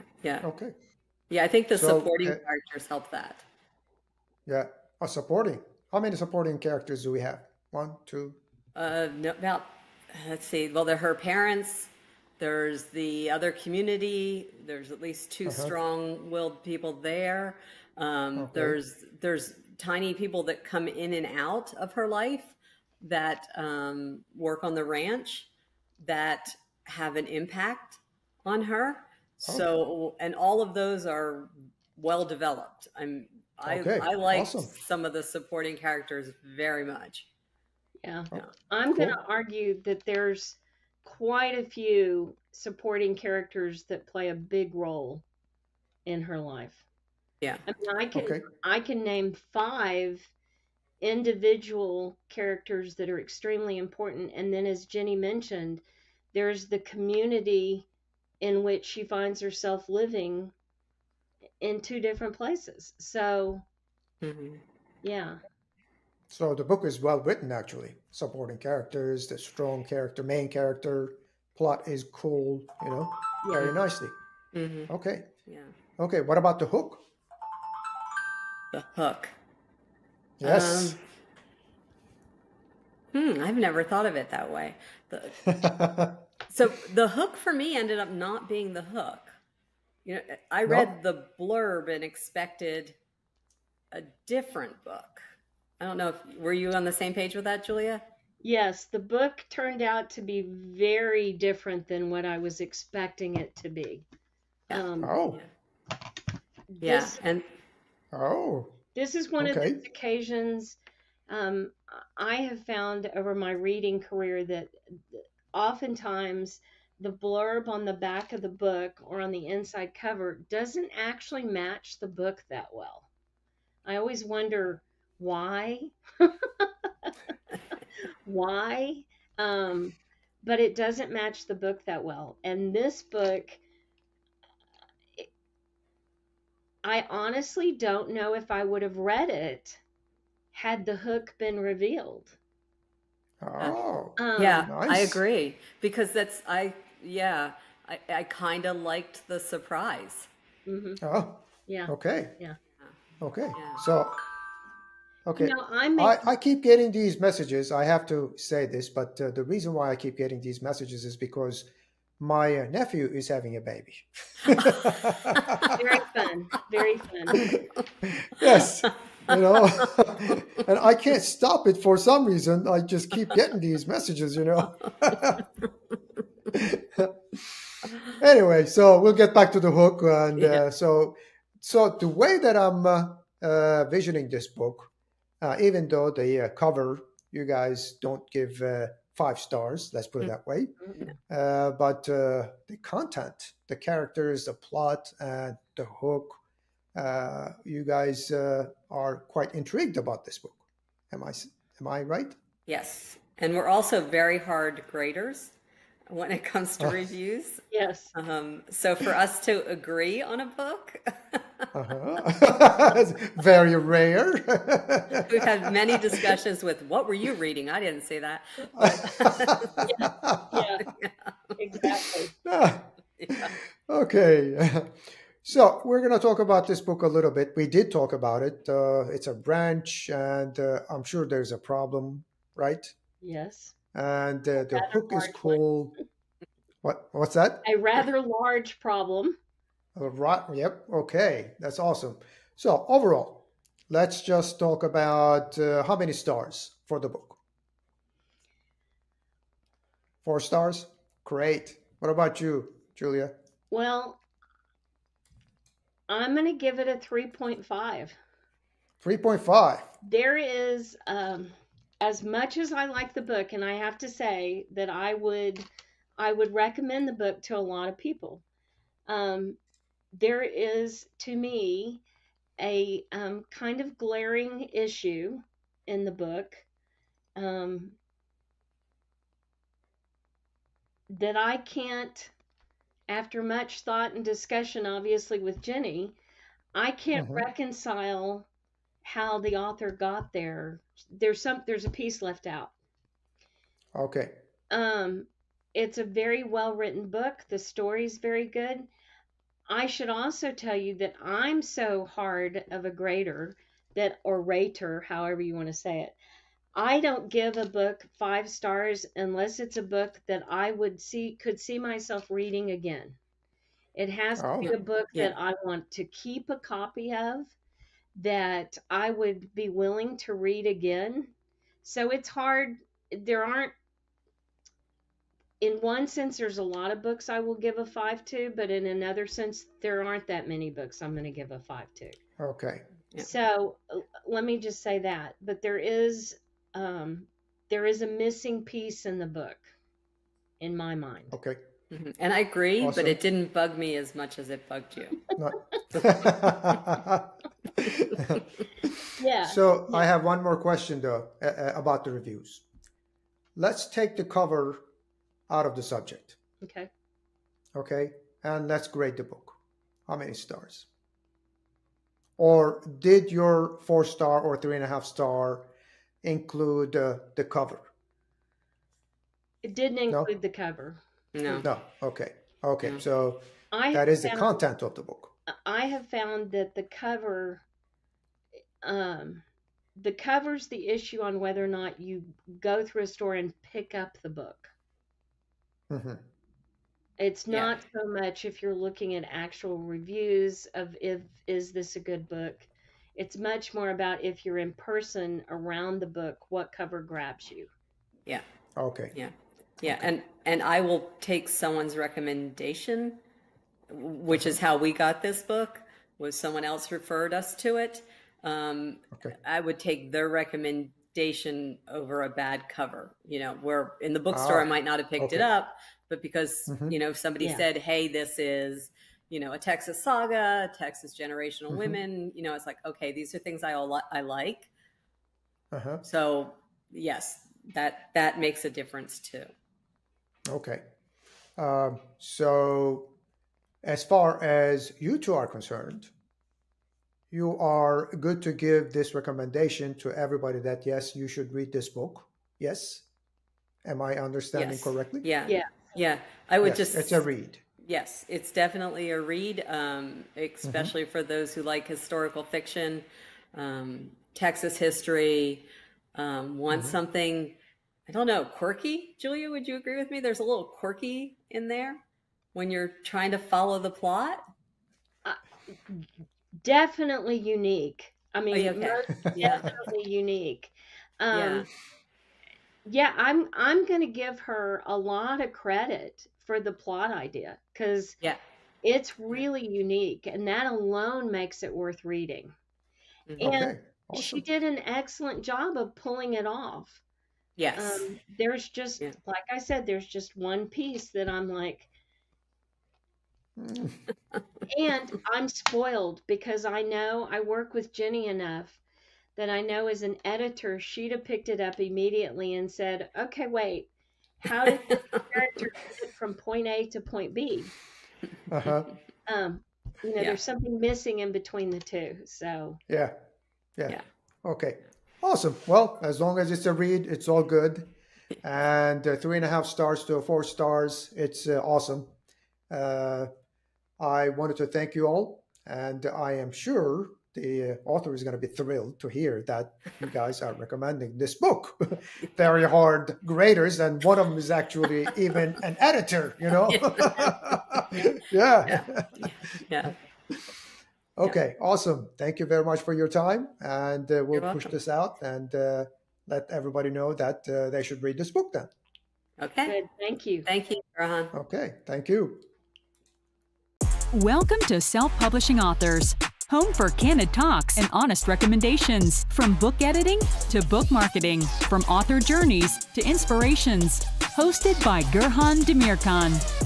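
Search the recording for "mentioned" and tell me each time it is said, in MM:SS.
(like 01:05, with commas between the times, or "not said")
00:55.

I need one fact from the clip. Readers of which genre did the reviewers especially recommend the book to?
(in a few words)
Historical fiction.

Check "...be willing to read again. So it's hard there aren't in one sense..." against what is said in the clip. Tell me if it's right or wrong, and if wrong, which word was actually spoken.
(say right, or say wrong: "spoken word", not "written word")
right.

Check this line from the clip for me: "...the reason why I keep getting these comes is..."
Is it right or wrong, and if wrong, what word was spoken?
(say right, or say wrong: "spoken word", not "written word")
wrong: "messages", not "comes".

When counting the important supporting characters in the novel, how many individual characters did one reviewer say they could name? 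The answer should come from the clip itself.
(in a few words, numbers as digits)
5.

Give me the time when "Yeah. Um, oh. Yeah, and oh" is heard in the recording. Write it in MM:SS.
01:44.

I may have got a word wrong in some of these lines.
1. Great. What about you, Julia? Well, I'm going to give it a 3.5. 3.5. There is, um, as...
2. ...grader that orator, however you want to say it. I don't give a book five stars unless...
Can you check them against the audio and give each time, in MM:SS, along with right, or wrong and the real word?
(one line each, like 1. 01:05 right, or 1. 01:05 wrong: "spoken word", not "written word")
1. 04:11 right
2. 05:02 right.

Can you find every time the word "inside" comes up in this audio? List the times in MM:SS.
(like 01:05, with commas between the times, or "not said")
01:59.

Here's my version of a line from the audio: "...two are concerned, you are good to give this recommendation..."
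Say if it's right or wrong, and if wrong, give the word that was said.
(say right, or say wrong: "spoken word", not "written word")
right.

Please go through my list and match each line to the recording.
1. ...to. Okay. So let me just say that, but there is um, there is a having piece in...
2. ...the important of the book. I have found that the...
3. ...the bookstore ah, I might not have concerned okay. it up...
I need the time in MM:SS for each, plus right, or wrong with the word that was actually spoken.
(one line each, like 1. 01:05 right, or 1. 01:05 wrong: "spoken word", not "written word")
1. 05:31 wrong: "missing", not "having"
2. 06:14 wrong: "content", not "important"
3. 06:54 wrong: "picked", not "concerned".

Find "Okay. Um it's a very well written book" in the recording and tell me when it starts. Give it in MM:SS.
04:53.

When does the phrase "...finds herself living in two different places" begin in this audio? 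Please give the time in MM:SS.
00:59.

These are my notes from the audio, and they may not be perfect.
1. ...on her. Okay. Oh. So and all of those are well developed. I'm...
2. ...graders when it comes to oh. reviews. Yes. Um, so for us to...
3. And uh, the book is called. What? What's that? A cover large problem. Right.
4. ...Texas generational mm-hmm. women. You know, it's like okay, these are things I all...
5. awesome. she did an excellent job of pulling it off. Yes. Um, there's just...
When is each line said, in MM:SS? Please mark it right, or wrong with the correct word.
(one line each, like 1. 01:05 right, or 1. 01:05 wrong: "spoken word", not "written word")
1. 00:28 right
2. 03:24 right
3. 03:53 wrong: "rather", not "cover"
4. 07:00 right
5. 08:04 right.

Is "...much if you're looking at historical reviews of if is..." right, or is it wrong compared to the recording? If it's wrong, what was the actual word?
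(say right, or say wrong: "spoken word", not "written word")
wrong: "actual", not "historical".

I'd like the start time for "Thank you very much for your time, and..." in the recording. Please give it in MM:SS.
09:02.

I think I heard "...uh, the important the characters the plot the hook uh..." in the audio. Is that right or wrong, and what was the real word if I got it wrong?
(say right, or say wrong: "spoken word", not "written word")
wrong: "content", not "important".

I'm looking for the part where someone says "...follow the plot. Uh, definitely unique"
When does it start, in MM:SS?
07:43.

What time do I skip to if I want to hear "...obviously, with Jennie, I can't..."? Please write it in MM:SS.
04:44.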